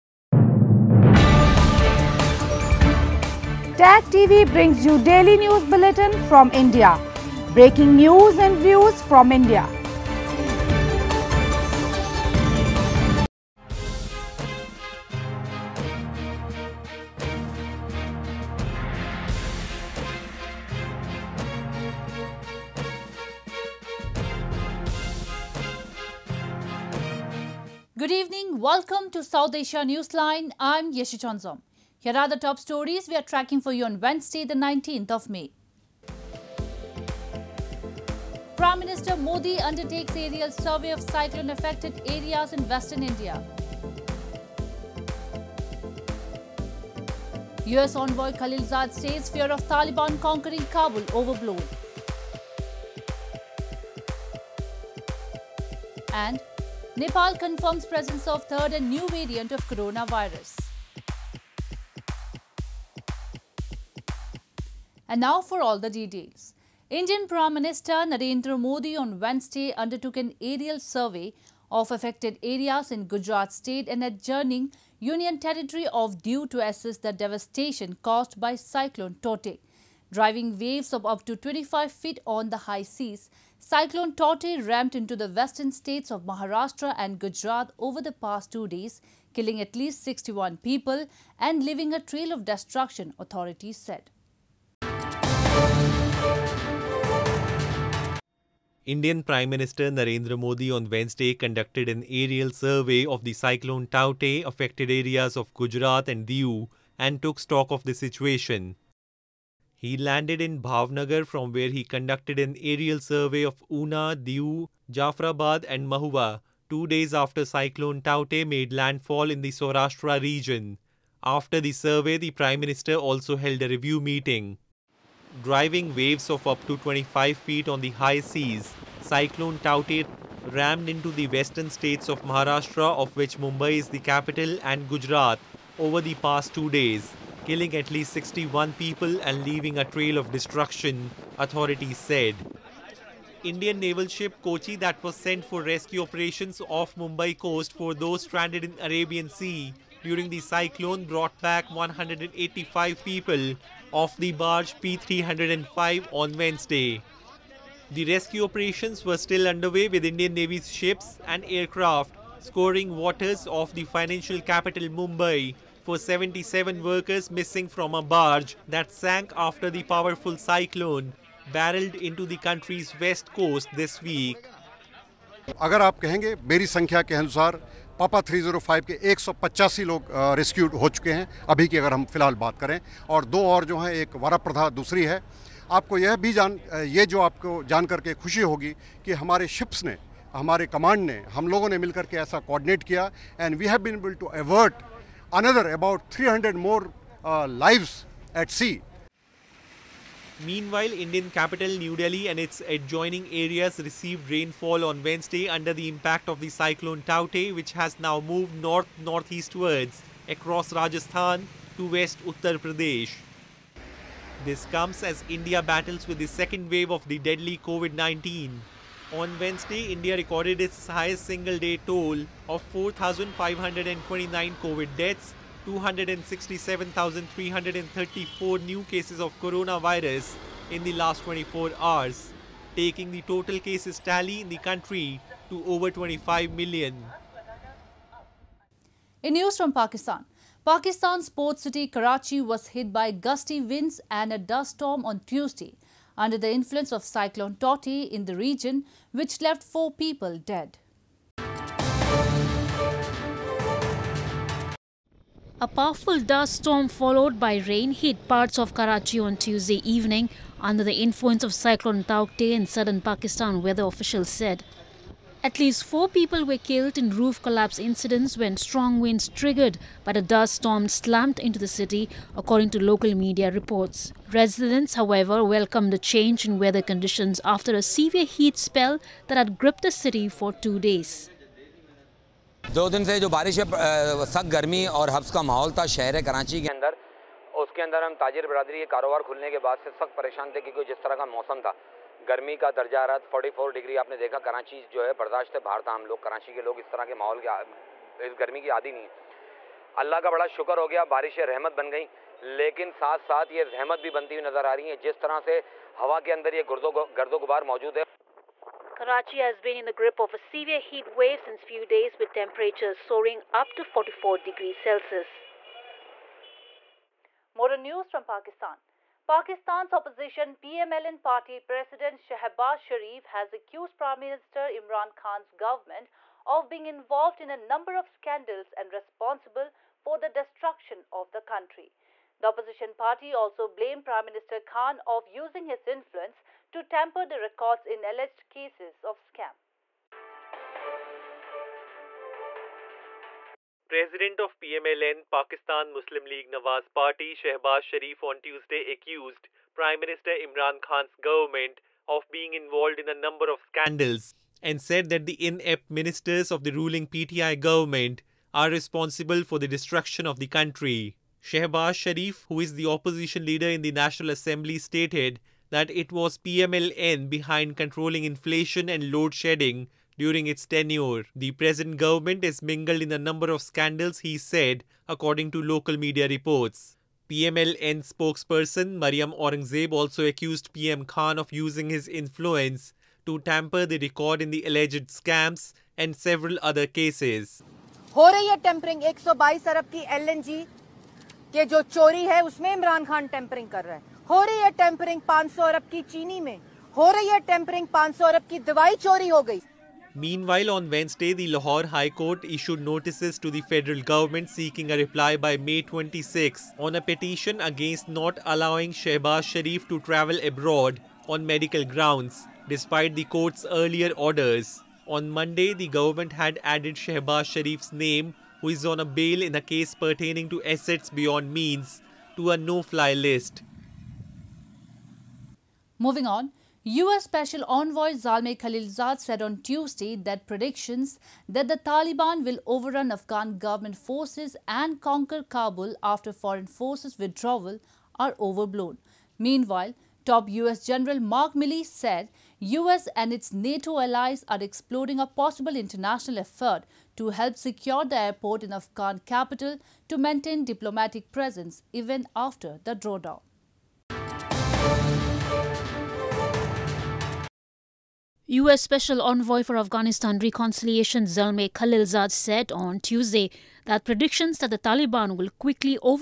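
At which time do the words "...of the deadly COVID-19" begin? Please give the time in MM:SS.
03:36.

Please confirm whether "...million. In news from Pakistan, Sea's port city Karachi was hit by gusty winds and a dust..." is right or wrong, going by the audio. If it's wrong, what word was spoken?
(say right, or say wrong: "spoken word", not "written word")
wrong: "Pakistan", not "Sea".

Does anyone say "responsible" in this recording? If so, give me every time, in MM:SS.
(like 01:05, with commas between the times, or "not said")
05:28, 05:58.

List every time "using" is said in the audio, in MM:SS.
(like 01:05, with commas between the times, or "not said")
05:35, 06:21.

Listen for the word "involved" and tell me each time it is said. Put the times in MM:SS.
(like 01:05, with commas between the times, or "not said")
05:26, 05:52.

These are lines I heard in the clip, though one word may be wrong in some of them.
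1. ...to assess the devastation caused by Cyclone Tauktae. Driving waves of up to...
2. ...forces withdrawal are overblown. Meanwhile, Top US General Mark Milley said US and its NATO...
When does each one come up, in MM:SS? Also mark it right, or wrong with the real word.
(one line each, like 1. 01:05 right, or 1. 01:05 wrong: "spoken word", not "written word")
1. 01:16 right
2. 07:16 right.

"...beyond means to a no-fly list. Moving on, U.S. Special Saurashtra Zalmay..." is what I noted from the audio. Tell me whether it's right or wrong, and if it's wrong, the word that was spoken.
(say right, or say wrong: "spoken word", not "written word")
wrong: "Envoy", not "Saurashtra".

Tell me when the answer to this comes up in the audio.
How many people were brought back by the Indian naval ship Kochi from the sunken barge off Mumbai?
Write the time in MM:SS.
02:31.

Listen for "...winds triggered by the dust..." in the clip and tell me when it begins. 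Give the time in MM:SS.
04:28.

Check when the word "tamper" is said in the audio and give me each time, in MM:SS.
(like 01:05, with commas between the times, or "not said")
05:36, 06:23.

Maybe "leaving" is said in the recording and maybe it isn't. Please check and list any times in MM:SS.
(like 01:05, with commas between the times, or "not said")
01:31, 02:19.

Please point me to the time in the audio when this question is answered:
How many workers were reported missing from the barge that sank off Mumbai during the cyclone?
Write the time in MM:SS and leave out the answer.
02:45.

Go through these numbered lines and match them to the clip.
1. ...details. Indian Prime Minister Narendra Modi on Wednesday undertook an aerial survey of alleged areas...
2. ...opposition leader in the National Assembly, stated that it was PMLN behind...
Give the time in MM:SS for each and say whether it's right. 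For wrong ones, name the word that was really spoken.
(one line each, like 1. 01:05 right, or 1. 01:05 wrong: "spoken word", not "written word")
1. 01:05 wrong: "affected", not "alleged"
2. 06:02 right.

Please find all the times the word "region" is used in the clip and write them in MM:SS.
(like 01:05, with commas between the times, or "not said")
02:00, 04:08.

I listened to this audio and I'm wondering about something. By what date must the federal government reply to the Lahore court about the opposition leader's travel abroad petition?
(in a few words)
May 26.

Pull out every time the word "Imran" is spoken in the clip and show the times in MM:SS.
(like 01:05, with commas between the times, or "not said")
05:24, 05:50.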